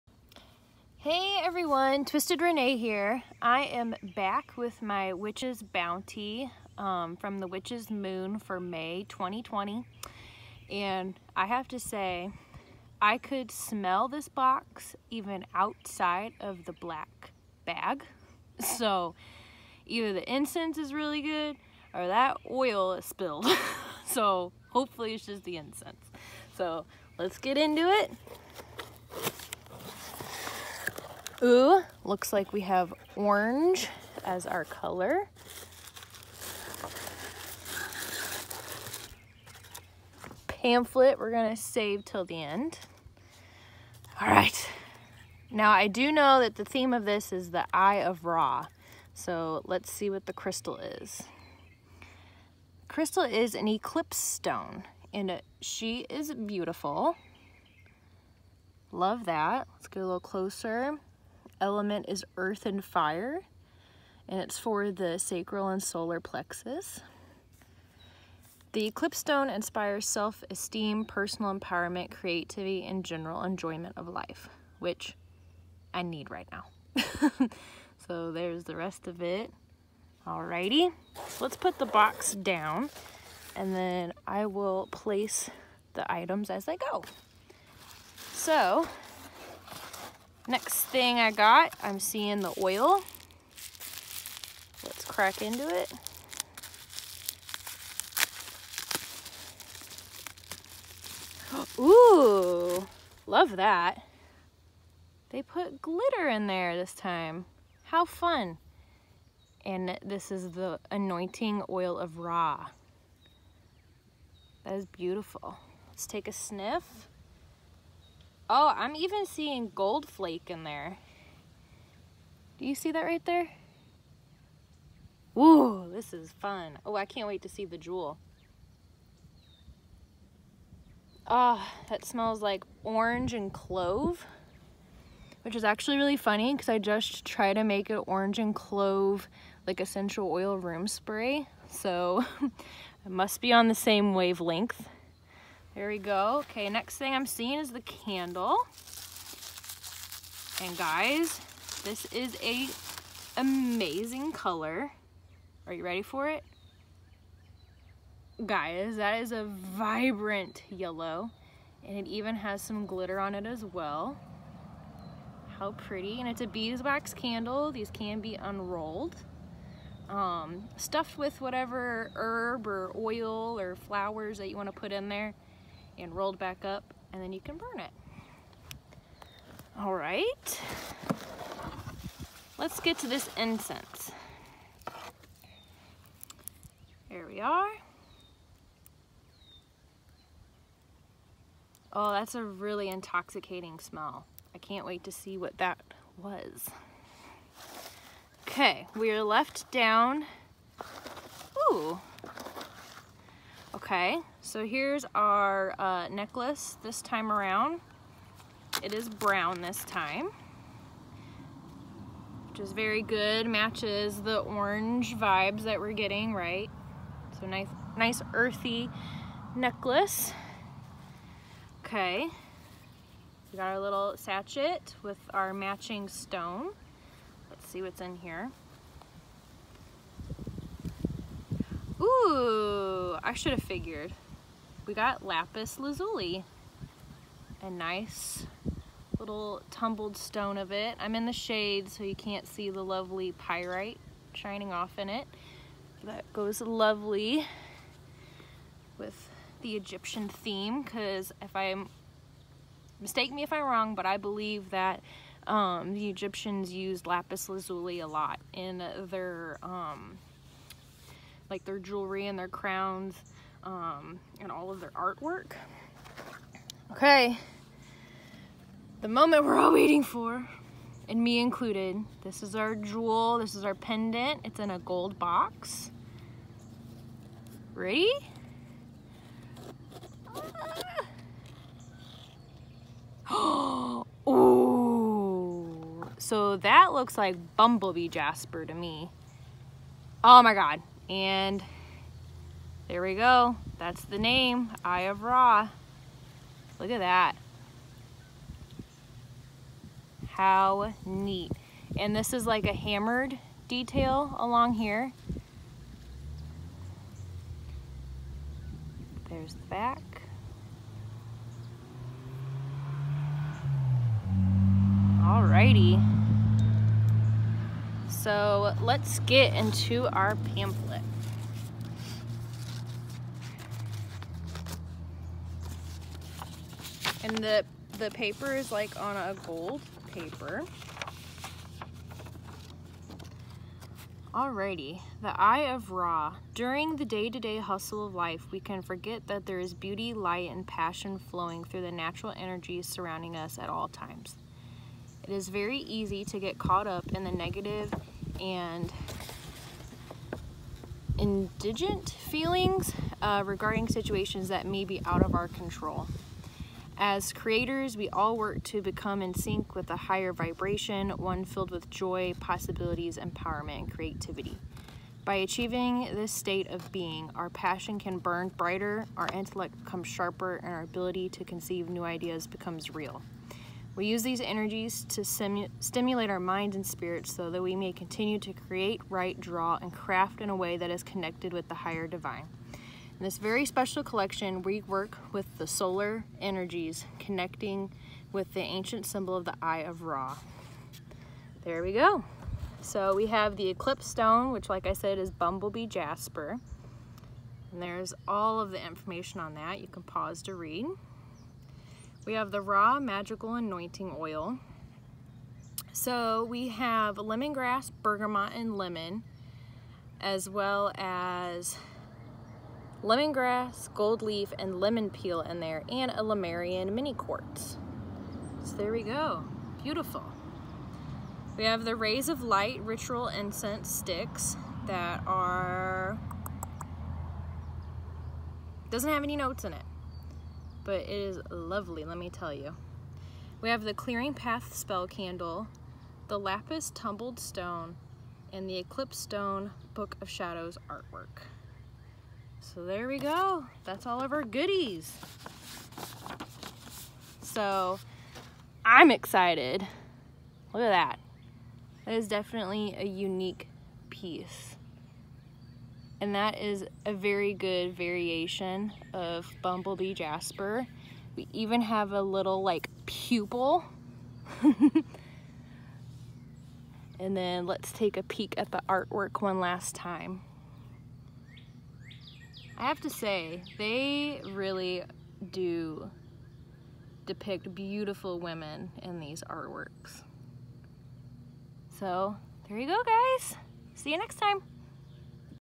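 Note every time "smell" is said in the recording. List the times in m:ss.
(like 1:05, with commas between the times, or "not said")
0:13, 2:12, 3:13.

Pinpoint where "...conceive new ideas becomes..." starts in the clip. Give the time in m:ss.
6:11.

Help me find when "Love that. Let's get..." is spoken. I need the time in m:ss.
0:58.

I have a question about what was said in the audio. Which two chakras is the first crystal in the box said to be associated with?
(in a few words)
Sacral and solar plexus.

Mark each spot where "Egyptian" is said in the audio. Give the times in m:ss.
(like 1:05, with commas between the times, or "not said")
4:09, 4:16.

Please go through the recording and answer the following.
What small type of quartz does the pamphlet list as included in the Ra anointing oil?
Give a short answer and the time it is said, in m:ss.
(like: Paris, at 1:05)
Lemurian mini quartz, at 6:56.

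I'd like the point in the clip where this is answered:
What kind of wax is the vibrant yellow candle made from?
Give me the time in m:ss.
2:46.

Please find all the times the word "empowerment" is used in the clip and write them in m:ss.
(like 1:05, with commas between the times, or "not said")
1:11, 6:03.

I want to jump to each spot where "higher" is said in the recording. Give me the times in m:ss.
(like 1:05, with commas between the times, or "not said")
5:59, 6:21.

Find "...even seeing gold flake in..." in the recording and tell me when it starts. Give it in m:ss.
1:58.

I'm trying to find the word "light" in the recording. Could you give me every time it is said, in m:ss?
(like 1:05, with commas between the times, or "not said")
5:40, 7:02.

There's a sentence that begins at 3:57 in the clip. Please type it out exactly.
A nice little tumbled stone of it.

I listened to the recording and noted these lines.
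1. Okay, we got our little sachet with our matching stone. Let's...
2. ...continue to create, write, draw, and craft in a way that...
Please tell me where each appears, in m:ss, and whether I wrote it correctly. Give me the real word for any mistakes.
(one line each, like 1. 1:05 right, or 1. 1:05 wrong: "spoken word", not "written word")
1. 3:41 right
2. 6:17 right.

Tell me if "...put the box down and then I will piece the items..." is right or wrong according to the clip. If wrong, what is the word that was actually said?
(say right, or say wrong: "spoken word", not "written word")
wrong: "place", not "piece".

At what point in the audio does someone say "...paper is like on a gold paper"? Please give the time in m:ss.
5:28.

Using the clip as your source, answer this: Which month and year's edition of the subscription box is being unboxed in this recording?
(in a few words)
May 2020.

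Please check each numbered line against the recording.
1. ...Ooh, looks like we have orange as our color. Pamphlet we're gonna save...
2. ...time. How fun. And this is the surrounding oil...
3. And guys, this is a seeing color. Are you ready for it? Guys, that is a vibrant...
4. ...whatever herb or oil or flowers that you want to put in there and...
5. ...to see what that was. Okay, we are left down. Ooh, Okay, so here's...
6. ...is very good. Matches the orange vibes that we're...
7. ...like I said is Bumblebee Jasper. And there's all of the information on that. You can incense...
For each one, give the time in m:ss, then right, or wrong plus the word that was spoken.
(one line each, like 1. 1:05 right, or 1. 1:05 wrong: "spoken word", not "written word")
1. 0:31 right
2. 1:46 wrong: "anointing", not "surrounding"
3. 2:30 wrong: "amazing", not "seeing"
4. 2:51 right
5. 3:15 right
6. 3:32 right
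7. 6:34 wrong: "pause", not "incense".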